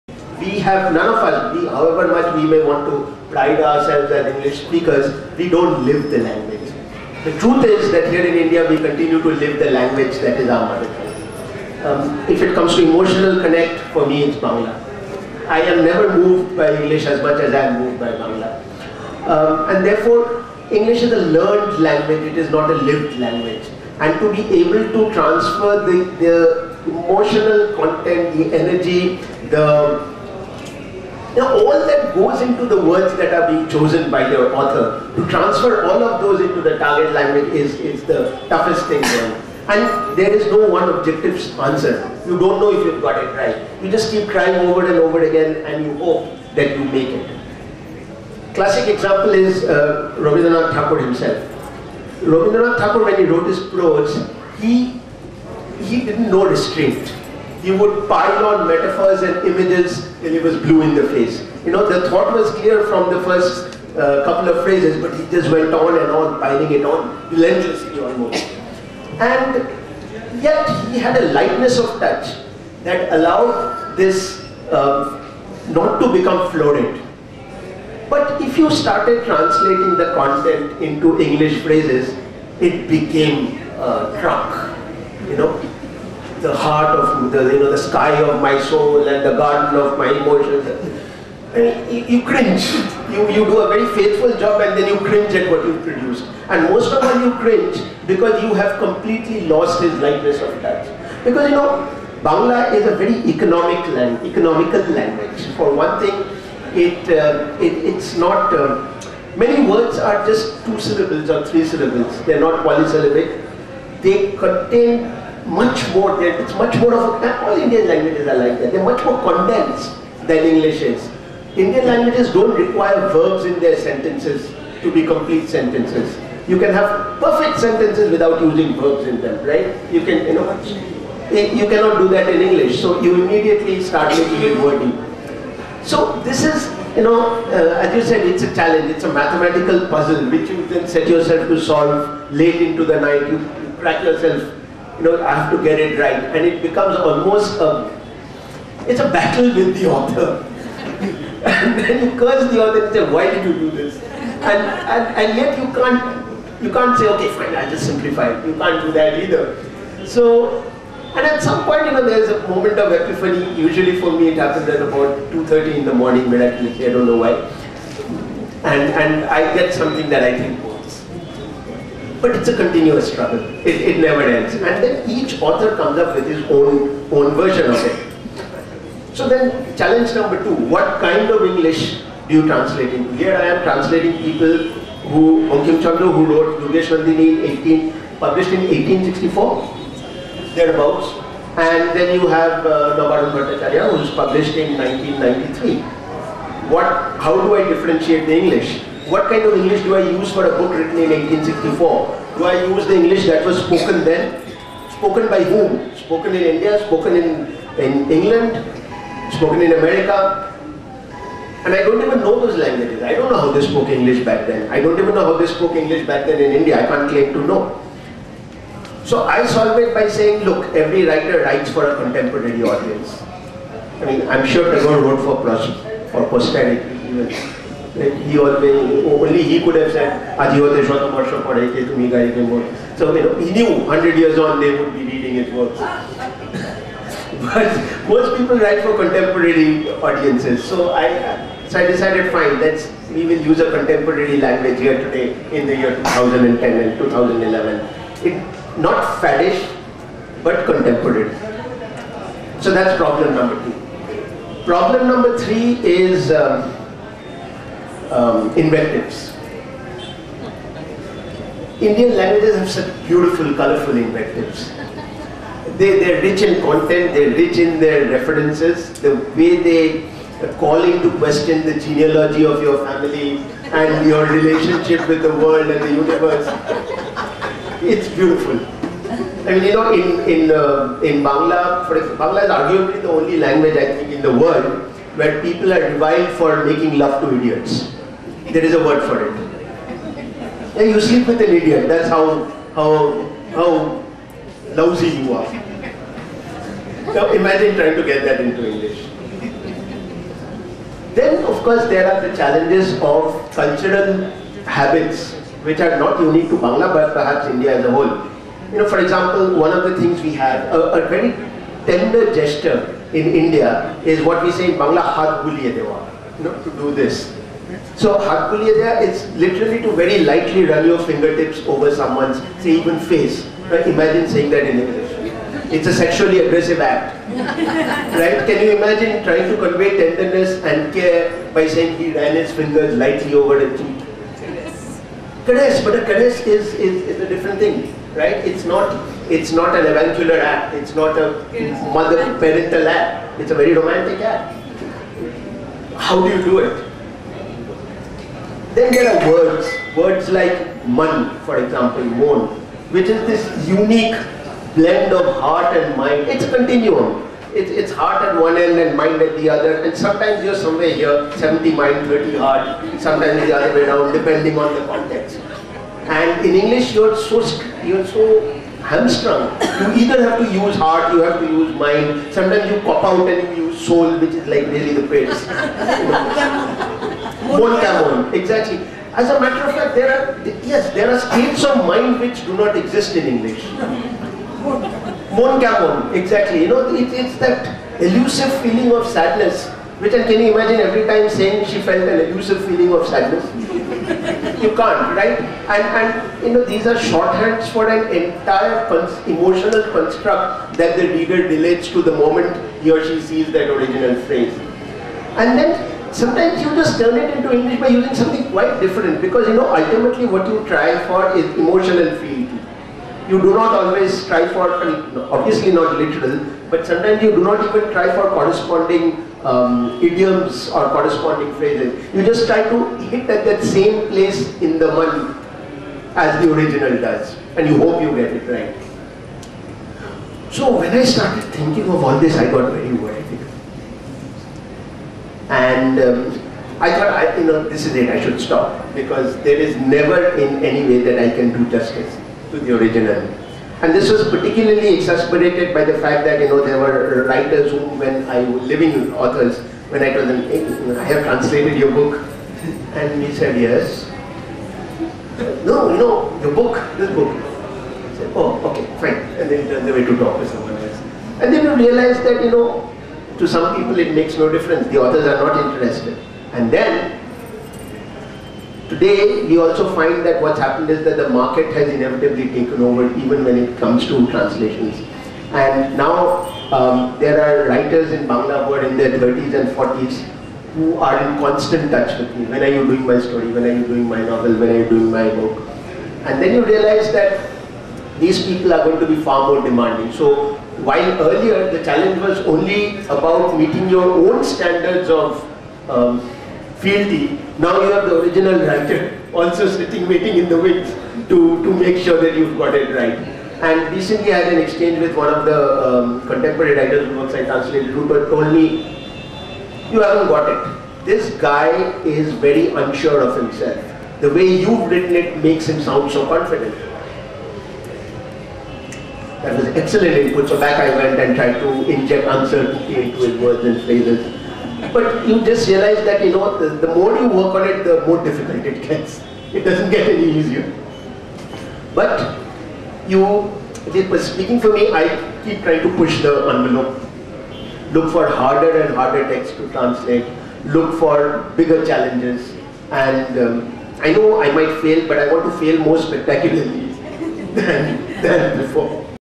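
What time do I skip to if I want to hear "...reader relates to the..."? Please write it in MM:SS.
06:41.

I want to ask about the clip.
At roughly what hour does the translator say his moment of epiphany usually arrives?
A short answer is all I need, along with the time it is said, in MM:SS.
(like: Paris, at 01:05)
2:30 a.m., at 02:45.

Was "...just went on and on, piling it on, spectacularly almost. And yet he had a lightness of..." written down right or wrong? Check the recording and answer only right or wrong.
wrong.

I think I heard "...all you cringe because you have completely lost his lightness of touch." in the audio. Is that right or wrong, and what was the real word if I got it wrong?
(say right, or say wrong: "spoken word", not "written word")
right.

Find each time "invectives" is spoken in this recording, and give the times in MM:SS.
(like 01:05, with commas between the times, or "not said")
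04:18, 04:23.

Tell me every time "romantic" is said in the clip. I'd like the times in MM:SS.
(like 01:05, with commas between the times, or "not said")
05:43.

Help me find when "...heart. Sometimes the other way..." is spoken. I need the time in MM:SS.
06:02.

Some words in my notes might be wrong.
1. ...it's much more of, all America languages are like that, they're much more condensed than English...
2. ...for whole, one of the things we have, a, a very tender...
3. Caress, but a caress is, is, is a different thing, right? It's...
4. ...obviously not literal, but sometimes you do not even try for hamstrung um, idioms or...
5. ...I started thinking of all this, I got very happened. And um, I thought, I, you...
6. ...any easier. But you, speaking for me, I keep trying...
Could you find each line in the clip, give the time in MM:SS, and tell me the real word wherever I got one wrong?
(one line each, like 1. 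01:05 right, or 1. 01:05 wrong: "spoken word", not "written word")
1. 01:56 wrong: "Indian", not "America"
2. 05:08 wrong: "example", not "whole"
3. 05:35 right
4. 06:55 wrong: "corresponding", not "hamstrung"
5. 07:10 wrong: "worried", not "happened"
6. 08:50 right.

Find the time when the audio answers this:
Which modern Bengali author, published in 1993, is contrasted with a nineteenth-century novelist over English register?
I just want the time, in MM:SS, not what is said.
03:12.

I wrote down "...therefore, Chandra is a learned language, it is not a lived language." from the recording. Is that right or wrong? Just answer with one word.
wrong.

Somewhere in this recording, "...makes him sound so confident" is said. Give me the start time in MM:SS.
08:35.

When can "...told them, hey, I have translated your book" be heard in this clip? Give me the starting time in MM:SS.
07:30.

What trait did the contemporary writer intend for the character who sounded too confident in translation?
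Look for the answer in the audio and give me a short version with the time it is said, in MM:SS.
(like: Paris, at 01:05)
unsure of himself, at 08:32.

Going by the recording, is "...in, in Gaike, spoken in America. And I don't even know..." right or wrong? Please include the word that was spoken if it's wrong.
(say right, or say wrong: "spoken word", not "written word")
wrong: "England", not "Gaike".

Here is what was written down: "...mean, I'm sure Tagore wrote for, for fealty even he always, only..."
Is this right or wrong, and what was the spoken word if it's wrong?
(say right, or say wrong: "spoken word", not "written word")
wrong: "posterity", not "fealty".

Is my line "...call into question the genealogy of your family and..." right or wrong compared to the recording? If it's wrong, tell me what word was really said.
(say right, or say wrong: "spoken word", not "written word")
right.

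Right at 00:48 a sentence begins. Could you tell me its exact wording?
Classic example is uh, Rabindranath Tagore himself.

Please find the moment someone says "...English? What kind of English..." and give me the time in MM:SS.
03:18.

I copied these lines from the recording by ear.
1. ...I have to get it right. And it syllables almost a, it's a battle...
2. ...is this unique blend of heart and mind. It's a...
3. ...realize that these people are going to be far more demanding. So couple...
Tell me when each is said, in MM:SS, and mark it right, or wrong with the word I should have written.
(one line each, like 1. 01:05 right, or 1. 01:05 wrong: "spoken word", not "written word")
1. 02:25 wrong: "becomes", not "syllables"
2. 05:53 right
3. 08:06 wrong: "while", not "couple".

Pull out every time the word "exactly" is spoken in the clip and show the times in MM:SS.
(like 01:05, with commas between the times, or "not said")
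06:18, 06:26.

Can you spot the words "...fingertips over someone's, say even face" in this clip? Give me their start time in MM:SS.
05:20.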